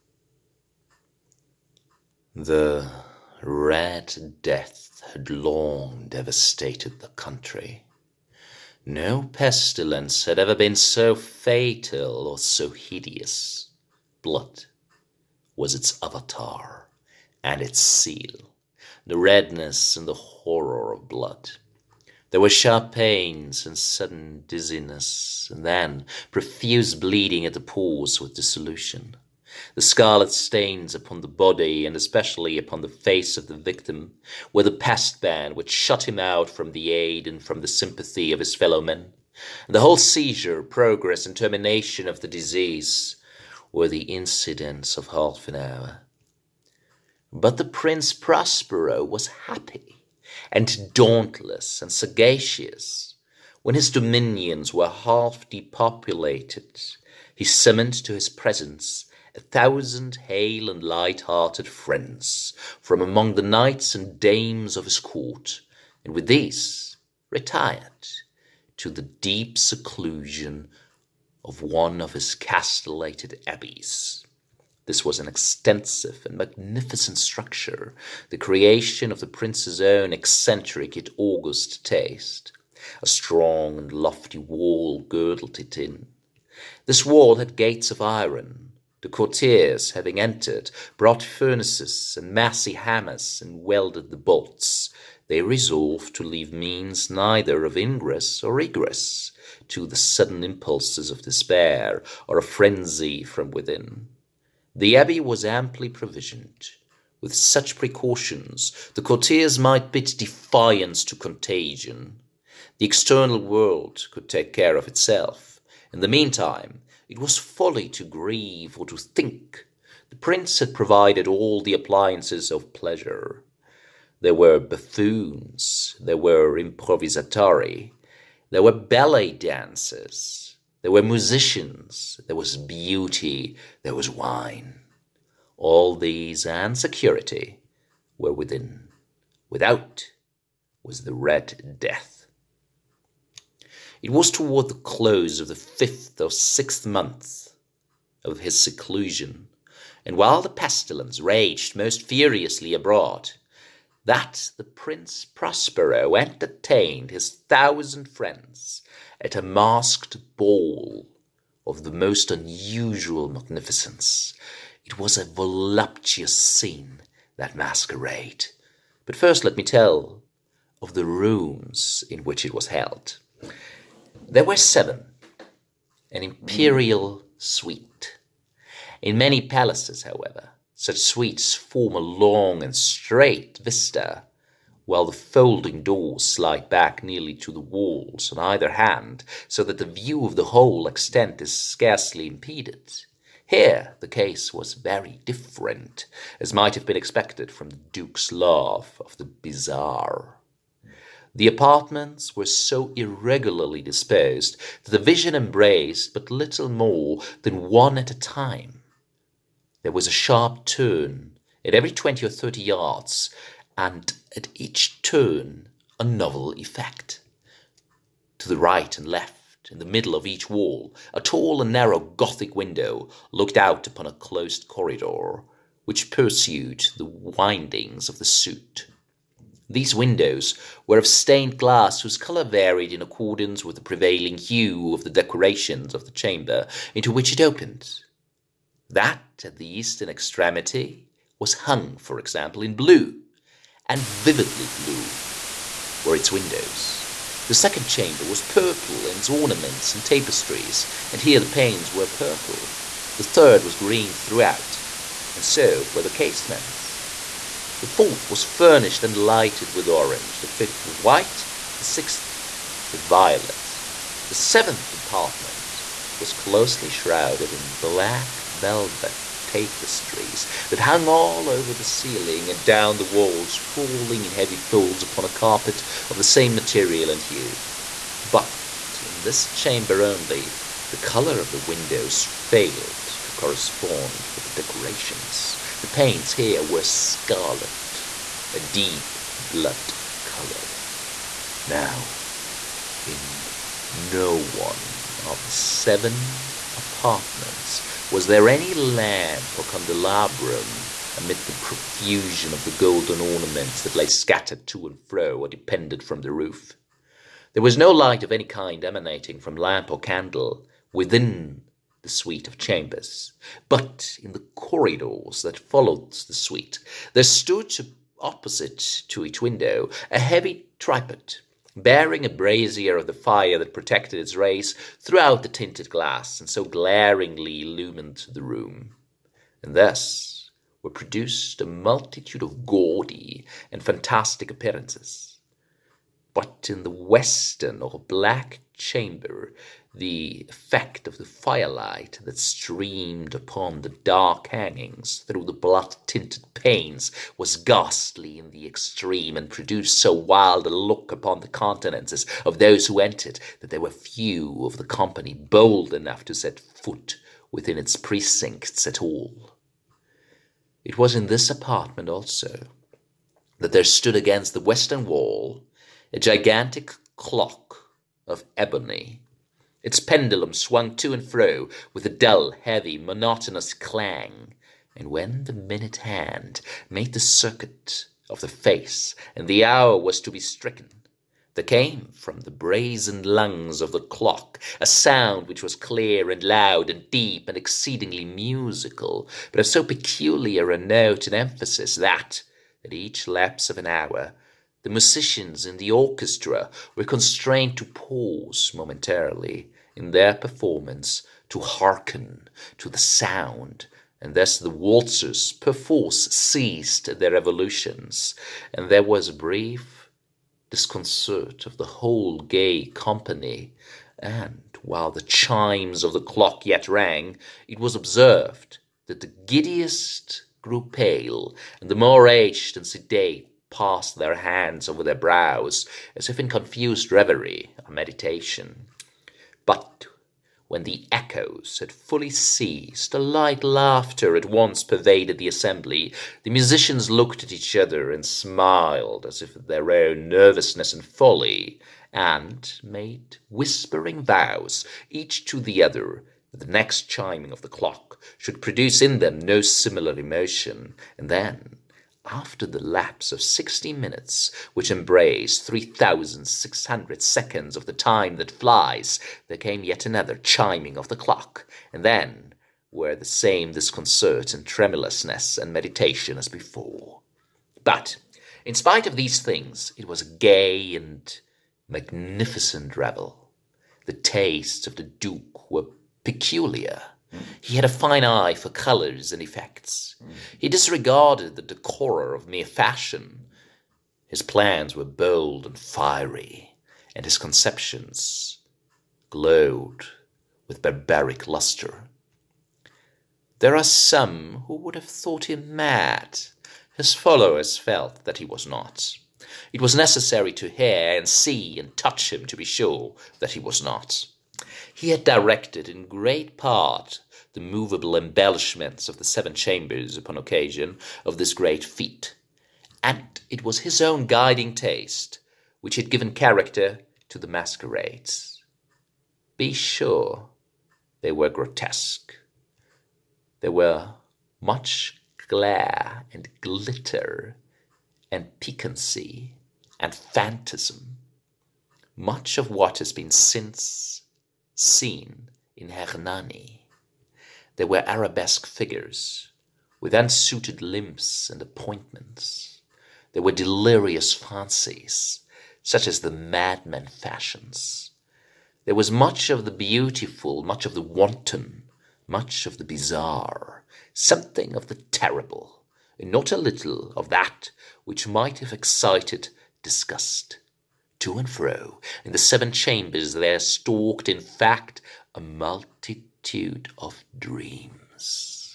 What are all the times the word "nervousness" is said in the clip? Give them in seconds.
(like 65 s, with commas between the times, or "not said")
440 s.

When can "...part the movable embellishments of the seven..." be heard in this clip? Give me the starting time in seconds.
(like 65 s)
506 s.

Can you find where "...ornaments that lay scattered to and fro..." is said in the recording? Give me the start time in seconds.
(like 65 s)
303 s.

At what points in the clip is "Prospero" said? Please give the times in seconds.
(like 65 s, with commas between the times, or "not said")
48 s, 155 s.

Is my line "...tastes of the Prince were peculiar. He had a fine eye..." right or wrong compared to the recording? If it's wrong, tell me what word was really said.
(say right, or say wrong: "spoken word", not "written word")
wrong: "Duke", not "Prince".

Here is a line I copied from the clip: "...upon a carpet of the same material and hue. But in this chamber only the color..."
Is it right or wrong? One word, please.
right.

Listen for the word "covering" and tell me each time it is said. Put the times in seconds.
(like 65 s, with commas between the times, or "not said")
not said.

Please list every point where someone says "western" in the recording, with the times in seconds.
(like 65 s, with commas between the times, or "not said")
336 s, 364 s.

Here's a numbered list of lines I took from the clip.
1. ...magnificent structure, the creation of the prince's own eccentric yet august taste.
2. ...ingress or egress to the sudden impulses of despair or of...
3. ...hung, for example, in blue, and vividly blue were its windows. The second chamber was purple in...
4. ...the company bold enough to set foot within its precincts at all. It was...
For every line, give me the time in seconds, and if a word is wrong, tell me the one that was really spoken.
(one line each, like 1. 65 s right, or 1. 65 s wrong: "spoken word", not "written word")
1. 76 s right
2. 97 s right
3. 241 s right
4. 354 s right.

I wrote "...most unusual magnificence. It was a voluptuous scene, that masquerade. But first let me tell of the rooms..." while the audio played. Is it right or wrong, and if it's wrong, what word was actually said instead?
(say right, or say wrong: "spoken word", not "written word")
right.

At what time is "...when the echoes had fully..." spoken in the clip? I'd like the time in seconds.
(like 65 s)
430 s.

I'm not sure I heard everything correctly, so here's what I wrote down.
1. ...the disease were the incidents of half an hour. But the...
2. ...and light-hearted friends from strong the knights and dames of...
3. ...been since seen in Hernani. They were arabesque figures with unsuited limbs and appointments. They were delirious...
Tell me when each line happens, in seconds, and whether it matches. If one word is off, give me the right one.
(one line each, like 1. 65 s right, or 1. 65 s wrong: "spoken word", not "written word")
1. 42 s right
2. 60 s wrong: "among", not "strong"
3. 533 s right.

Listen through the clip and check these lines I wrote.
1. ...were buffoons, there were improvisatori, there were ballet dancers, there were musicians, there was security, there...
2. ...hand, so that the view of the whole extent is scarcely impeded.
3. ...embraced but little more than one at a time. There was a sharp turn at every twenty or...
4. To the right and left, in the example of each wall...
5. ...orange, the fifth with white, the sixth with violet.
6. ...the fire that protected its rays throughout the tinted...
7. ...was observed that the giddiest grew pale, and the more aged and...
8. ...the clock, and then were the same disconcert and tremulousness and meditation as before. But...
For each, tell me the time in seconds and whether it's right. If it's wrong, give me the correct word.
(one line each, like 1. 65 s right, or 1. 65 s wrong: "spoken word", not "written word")
1. 124 s wrong: "beauty", not "security"
2. 188 s right
3. 205 s right
4. 218 s wrong: "middle", not "example"
5. 259 s right
6. 323 s right
7. 417 s right
8. 461 s right.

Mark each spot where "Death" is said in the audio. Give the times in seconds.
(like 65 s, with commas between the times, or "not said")
4 s, 141 s.